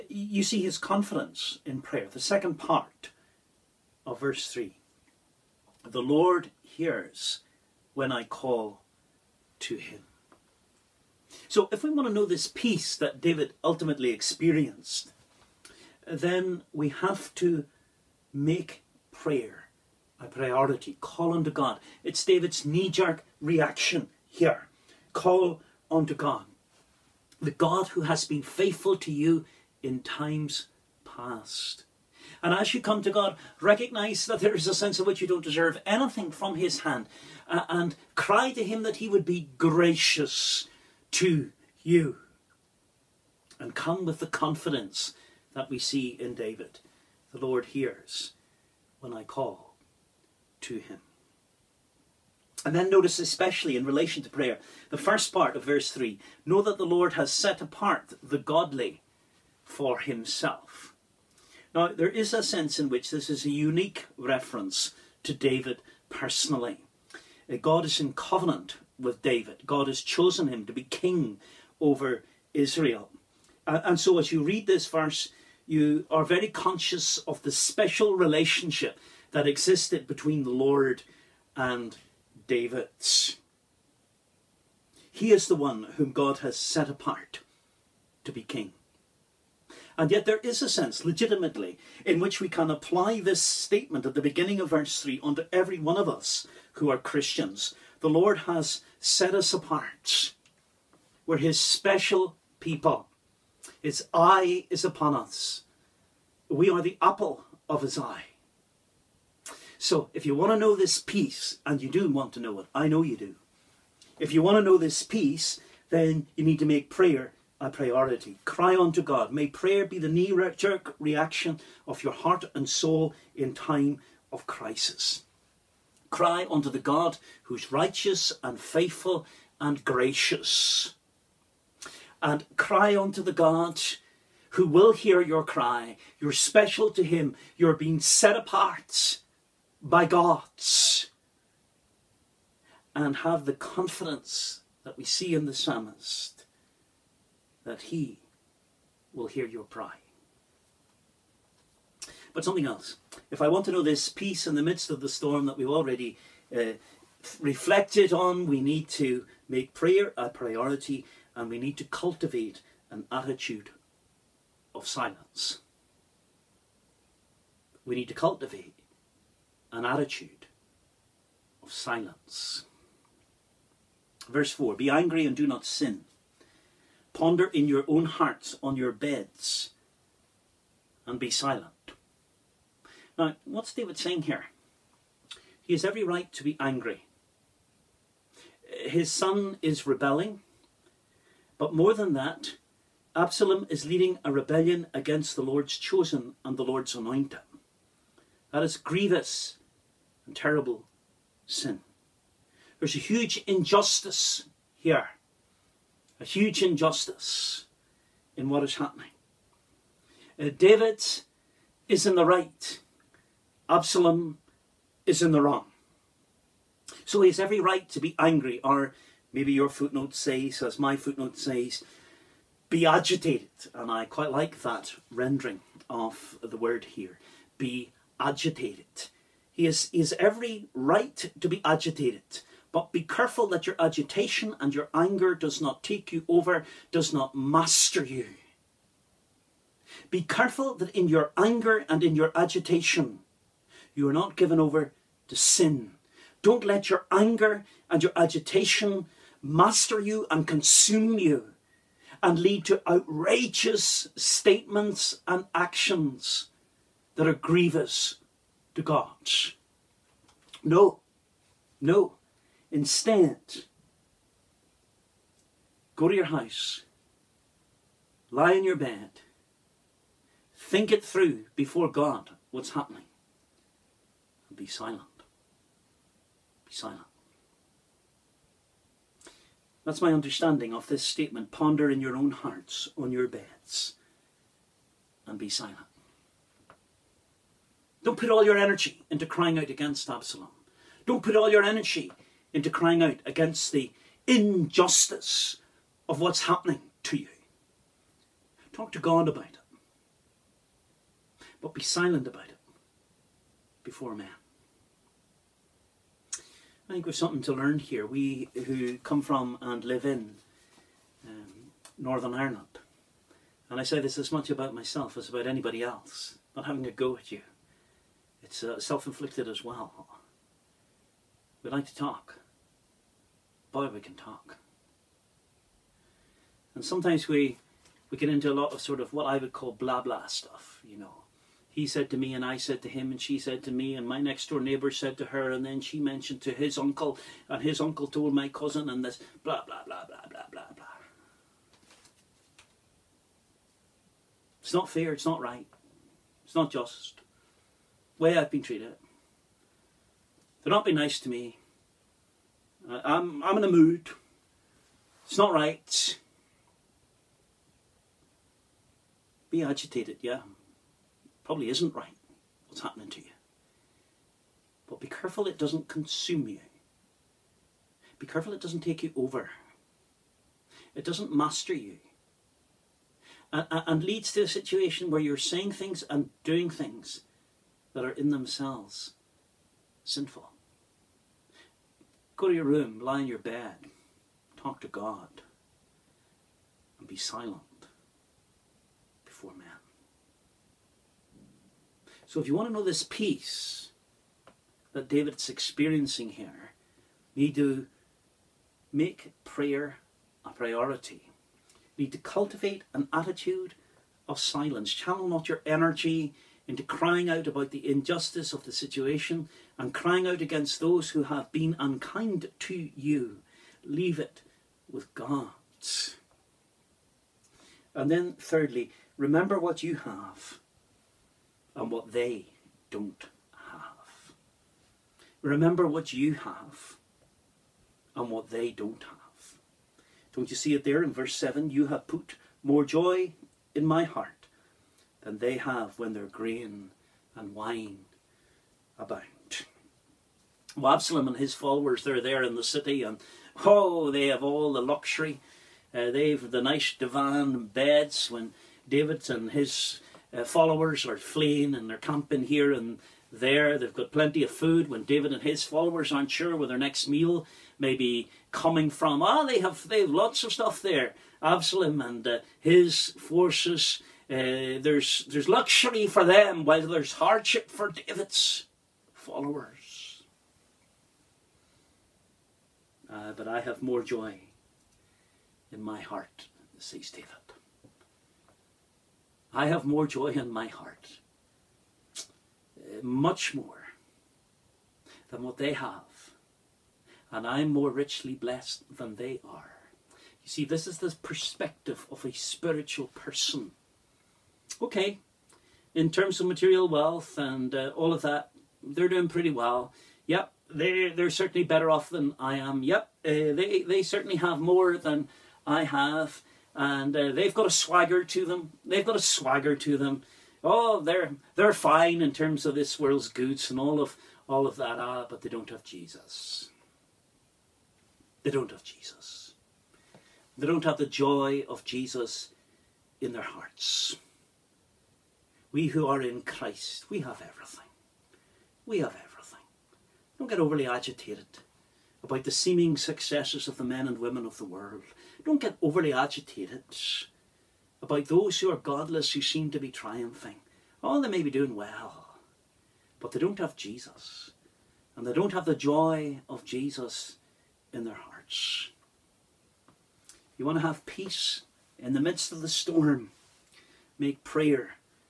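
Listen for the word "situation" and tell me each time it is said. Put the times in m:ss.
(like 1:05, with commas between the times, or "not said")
6:14, 6:48.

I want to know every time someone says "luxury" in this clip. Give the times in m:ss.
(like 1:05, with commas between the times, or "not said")
7:24, 7:45.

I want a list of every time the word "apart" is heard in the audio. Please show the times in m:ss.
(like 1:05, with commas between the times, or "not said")
0:57, 1:26, 1:39, 2:18.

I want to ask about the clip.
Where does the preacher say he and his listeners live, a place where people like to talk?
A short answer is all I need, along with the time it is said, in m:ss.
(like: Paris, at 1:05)
Northern Ireland, at 5:11.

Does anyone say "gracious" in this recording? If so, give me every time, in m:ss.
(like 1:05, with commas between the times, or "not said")
0:39, 2:09.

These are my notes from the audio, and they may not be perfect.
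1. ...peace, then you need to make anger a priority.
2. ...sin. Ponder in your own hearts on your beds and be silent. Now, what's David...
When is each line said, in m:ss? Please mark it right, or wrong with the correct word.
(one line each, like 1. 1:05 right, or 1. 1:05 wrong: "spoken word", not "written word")
1. 1:55 wrong: "prayer", not "anger"
2. 2:55 right.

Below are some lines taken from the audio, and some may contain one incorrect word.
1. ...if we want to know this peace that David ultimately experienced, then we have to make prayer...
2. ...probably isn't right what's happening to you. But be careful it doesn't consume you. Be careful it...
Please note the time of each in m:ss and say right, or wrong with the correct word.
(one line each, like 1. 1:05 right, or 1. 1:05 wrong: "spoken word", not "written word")
1. 0:11 right
2. 6:01 right.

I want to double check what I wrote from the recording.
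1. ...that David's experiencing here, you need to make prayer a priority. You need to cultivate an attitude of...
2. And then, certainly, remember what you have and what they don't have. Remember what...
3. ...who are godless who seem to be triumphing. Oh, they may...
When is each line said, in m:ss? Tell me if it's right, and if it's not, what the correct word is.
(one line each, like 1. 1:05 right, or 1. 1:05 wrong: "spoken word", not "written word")
1. 6:34 right
2. 6:57 wrong: "thirdly", not "certainly"
3. 8:58 right.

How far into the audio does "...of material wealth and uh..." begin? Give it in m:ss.
8:16.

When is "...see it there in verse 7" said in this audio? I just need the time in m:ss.
7:10.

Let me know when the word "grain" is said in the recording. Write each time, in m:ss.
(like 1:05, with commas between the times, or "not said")
7:16.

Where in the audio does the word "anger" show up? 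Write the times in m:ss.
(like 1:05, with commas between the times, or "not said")
3:54, 4:01, 4:07.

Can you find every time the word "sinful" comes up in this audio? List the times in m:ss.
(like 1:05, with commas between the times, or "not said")
6:20.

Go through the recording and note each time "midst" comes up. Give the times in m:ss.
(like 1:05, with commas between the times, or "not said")
2:34, 9:12.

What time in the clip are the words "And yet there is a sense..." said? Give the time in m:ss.
1:29.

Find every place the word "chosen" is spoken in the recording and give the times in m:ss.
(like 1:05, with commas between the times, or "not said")
1:10, 3:15.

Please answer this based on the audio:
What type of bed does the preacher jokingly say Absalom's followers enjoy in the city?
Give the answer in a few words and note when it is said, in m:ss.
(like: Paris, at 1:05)
divan beds, at 7:26.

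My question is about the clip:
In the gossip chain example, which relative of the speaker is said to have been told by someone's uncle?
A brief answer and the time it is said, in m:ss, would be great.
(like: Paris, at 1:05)
cousin, at 5:38.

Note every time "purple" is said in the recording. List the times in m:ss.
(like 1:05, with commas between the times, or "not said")
not said.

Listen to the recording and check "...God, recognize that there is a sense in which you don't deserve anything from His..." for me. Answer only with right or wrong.
right.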